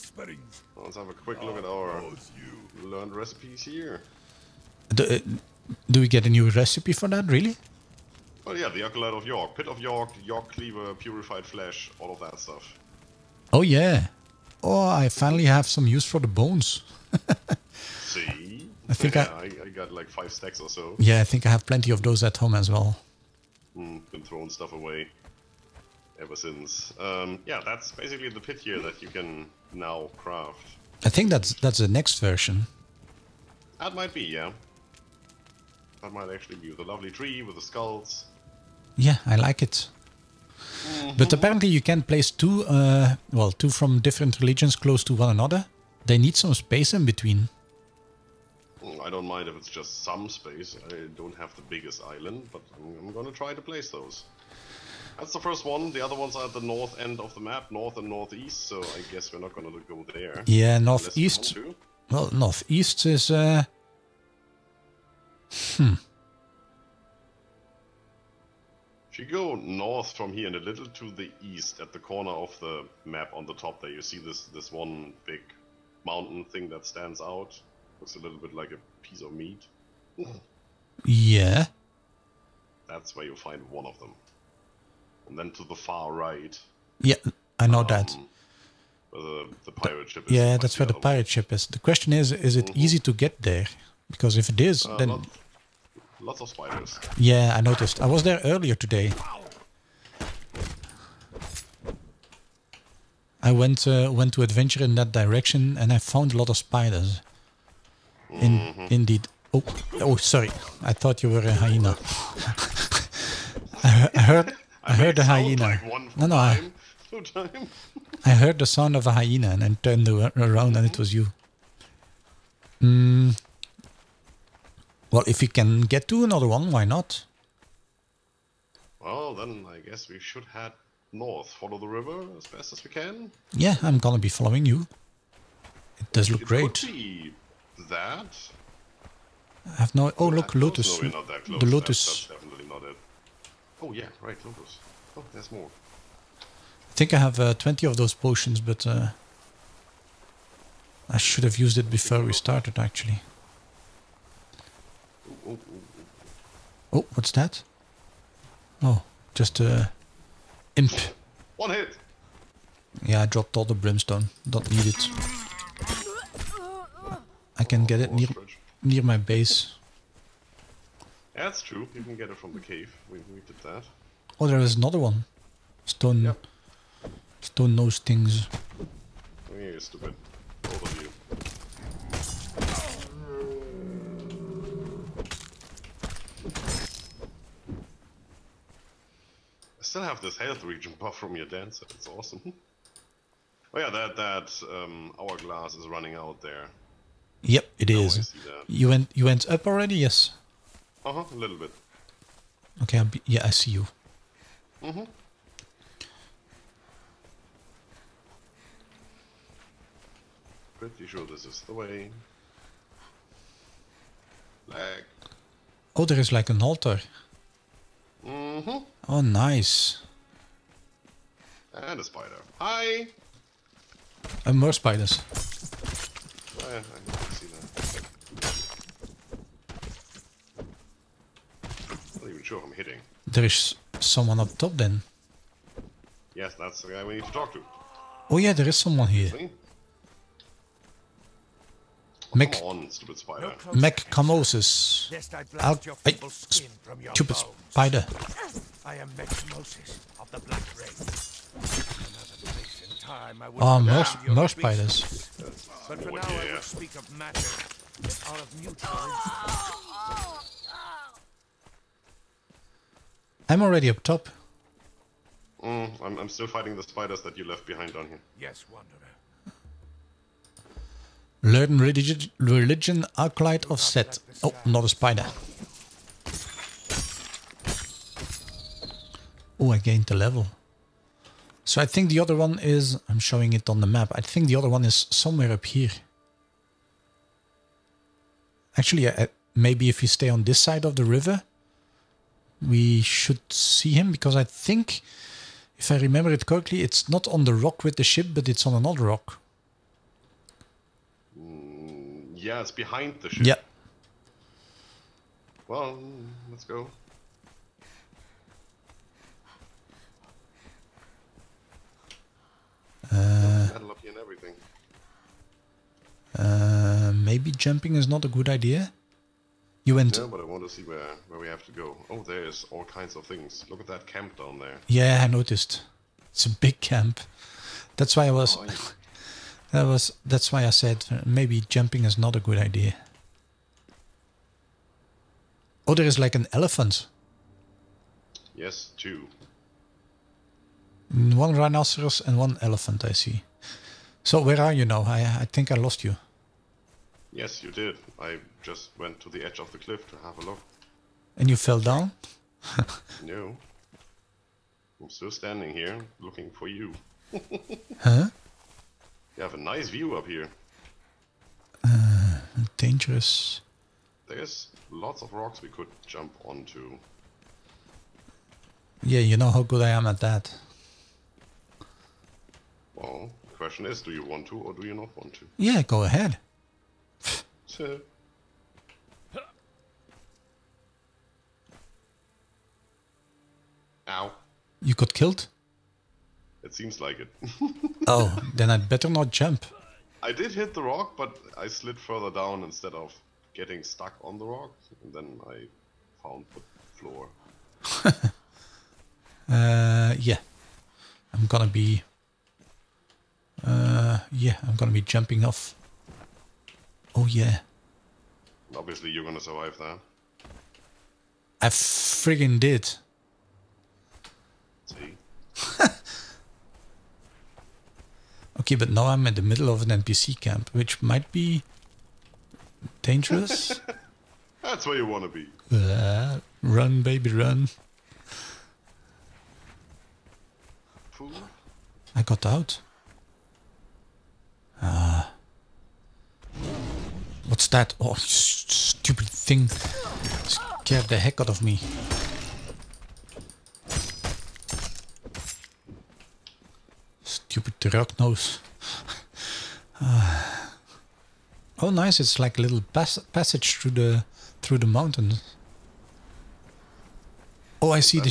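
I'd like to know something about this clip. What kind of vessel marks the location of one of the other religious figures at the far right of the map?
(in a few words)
Pirate ship.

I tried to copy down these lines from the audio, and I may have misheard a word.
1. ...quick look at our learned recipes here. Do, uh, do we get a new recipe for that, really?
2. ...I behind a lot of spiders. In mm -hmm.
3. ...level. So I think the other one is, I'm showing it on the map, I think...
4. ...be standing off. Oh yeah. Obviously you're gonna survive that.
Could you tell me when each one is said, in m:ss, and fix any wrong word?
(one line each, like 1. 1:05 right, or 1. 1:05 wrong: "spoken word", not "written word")
1. 0:01 right
2. 1:45 wrong: "found", not "behind"
3. 4:40 right
4. 6:44 wrong: "jumping", not "standing".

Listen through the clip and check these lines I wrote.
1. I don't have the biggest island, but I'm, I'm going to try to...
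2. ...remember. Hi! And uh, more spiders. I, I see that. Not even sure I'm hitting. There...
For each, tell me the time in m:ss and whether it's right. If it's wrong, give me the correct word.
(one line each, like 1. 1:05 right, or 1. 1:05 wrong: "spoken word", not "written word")
1. 0:50 right
2. 3:42 wrong: "spider", not "remember".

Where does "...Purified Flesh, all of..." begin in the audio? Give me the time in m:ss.
0:10.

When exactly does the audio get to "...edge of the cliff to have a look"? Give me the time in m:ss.
5:49.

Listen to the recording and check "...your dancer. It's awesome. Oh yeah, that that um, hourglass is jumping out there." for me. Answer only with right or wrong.
wrong.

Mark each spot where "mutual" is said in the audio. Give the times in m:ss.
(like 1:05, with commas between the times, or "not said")
4:18.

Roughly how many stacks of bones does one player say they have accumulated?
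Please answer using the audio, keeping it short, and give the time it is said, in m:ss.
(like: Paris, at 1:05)
5, at 0:20.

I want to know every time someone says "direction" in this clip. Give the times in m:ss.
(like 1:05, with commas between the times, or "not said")
1:45.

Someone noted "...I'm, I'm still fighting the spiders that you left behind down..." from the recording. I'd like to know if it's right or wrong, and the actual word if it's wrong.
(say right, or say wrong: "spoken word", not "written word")
right.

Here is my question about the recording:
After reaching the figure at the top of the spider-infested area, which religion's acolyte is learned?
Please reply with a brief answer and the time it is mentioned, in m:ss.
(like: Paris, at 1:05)
Set, at 4:33.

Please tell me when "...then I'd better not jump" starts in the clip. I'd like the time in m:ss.
6:28.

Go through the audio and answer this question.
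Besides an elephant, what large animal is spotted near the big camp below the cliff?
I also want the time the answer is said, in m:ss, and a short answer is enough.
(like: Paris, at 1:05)
Rhinoceros, at 5:41.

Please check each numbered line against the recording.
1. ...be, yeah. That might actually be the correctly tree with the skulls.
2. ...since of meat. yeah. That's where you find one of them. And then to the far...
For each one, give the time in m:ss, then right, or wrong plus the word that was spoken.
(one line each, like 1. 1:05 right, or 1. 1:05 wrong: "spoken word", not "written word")
1. 0:34 wrong: "lovely", not "correctly"
2. 1:19 wrong: "piece", not "since".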